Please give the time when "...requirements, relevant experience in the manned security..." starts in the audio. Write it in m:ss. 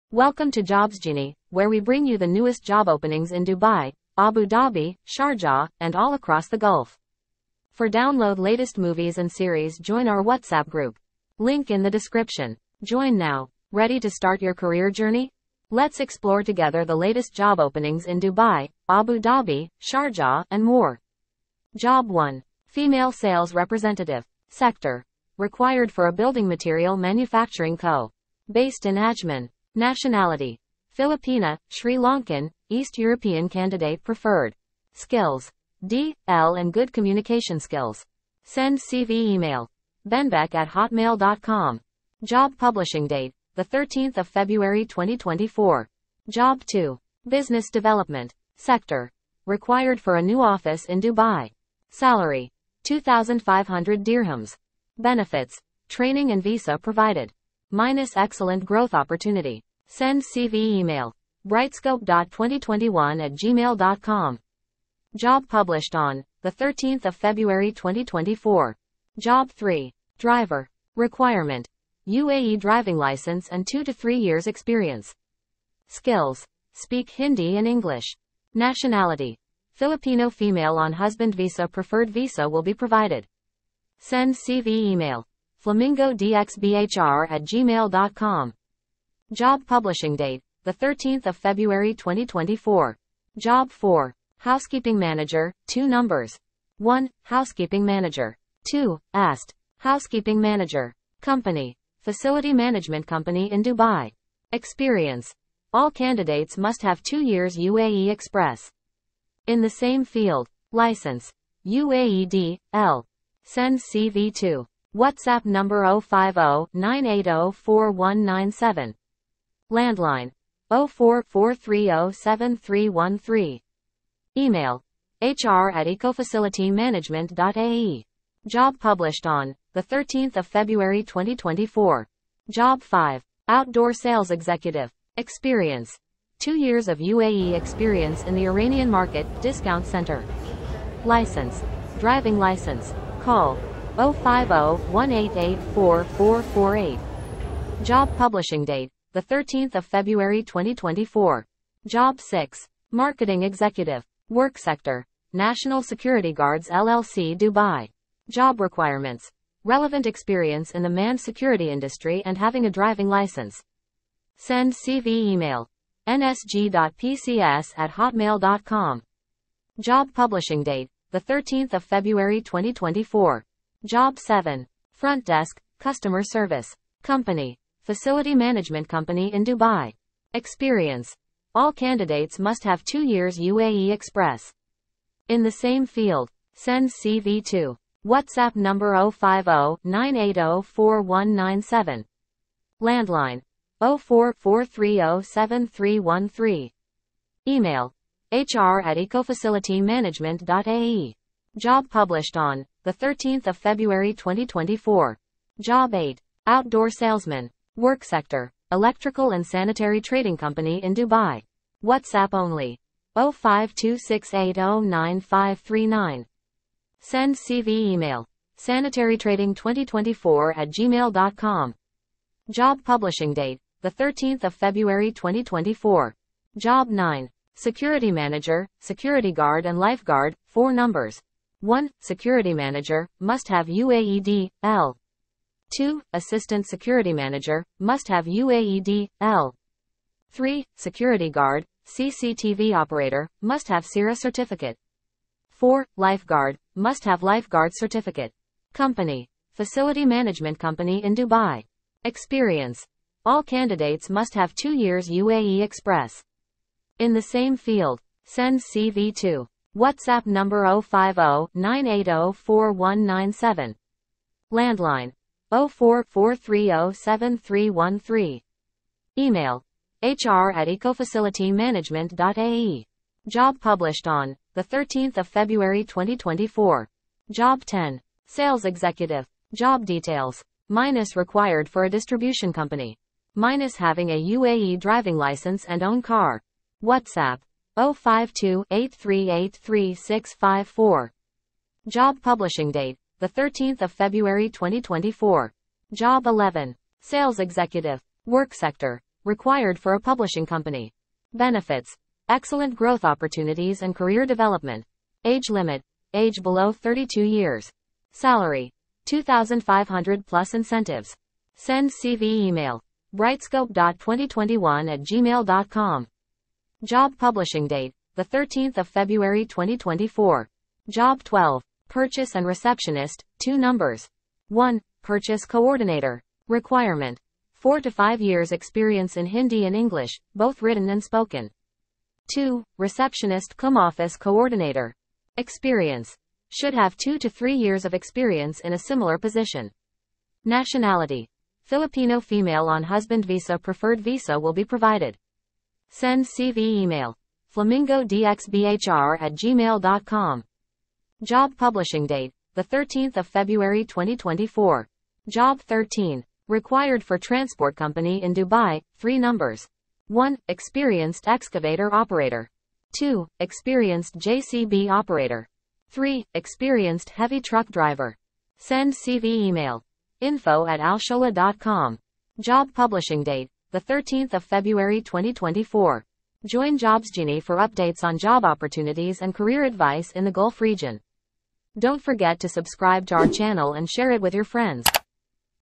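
2:38.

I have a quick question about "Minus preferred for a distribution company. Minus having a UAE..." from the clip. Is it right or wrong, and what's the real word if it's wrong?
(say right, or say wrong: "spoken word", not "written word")
wrong: "required", not "preferred".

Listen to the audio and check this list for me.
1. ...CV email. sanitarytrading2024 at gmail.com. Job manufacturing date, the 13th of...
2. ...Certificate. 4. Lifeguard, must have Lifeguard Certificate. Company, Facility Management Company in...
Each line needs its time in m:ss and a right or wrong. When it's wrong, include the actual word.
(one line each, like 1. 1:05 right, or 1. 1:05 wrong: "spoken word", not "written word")
1. 3:37 wrong: "publishing", not "manufacturing"
2. 4:04 right.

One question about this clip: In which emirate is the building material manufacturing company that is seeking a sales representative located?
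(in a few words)
Ajman.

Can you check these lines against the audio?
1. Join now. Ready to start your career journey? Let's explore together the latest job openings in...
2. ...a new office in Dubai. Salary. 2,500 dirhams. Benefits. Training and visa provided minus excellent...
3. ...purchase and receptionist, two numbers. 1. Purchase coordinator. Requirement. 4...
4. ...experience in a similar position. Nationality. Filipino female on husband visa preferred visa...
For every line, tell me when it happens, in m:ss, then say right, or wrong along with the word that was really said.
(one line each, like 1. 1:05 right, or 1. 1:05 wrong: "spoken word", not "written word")
1. 0:12 right
2. 0:50 right
3. 5:21 right
4. 5:37 right.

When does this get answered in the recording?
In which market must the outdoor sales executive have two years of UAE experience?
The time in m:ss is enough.
2:18.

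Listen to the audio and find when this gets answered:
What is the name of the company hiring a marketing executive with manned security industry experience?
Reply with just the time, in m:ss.
2:35.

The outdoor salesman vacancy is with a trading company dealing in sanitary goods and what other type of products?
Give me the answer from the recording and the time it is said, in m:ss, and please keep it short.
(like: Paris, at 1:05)
Electrical, at 3:28.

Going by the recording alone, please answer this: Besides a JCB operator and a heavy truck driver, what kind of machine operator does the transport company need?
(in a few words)
Excavator operator.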